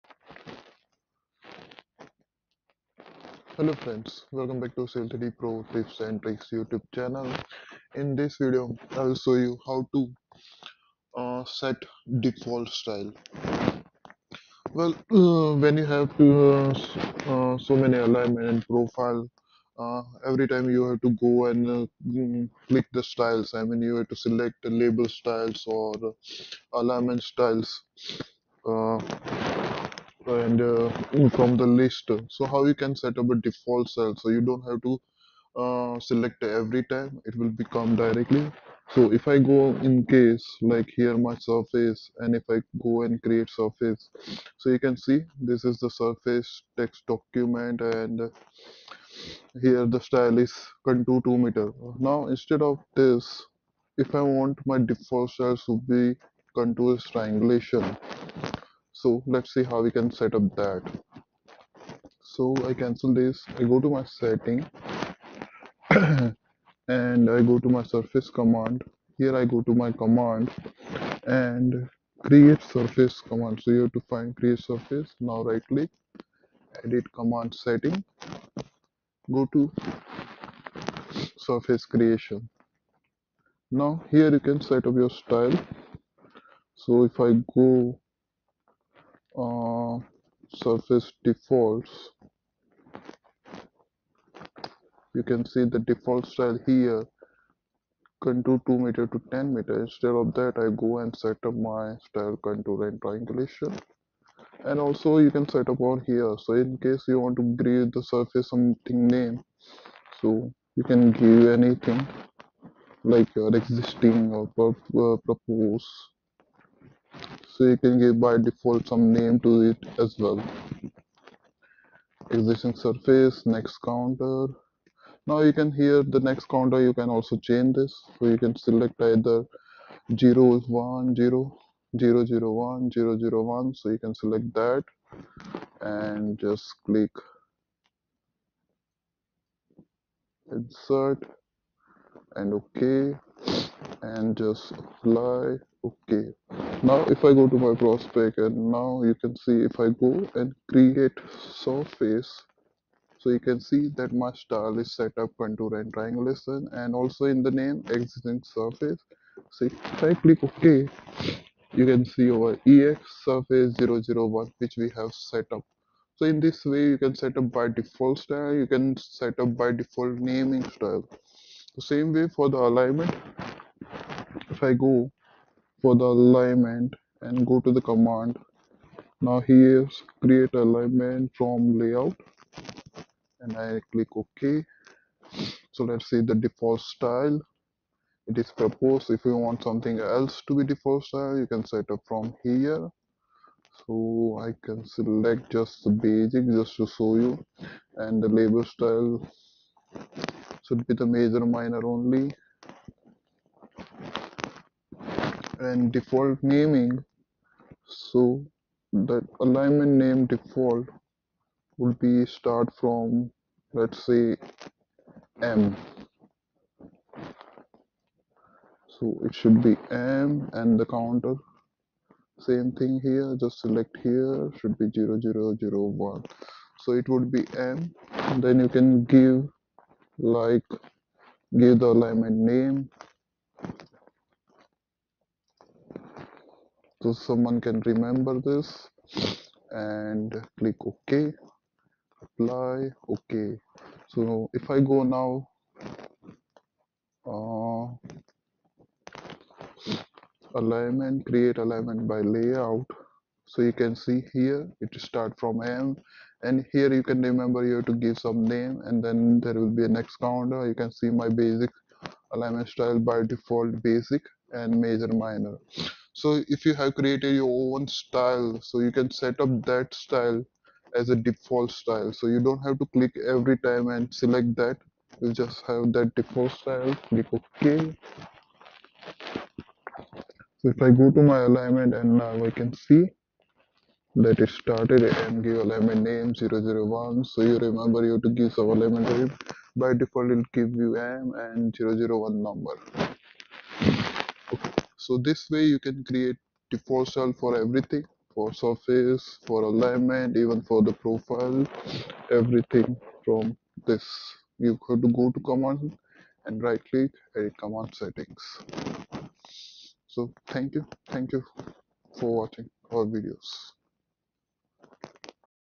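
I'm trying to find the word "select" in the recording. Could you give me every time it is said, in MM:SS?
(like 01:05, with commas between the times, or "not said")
00:24, 00:35, 02:08, 02:14, 03:14, 03:43, 04:34.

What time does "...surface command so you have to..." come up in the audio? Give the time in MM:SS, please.
01:12.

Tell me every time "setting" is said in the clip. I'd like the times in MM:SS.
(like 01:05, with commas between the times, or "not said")
01:04, 01:17, 05:08.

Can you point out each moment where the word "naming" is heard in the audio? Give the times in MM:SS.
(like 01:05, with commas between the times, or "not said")
02:50, 03:26.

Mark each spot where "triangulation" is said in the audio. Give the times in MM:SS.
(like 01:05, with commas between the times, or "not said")
00:56, 01:43, 02:35.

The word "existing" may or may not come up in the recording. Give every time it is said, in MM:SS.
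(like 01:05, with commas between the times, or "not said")
01:53, 02:02, 02:37.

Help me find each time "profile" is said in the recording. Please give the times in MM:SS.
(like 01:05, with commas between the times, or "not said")
00:18, 05:01.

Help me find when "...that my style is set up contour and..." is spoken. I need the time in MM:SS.
02:33.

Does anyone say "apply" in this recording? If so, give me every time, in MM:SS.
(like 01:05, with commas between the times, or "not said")
02:24, 04:02.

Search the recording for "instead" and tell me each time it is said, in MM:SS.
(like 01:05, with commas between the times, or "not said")
00:52, 01:39.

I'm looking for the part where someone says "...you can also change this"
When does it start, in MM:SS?
02:06.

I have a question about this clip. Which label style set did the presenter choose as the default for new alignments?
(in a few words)
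Major minor only.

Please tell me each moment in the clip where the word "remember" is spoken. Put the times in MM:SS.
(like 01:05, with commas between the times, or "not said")
03:57, 04:17, 04:47.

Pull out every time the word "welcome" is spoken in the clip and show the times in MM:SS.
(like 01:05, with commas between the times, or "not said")
00:04.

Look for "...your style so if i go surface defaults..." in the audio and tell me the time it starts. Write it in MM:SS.
01:24.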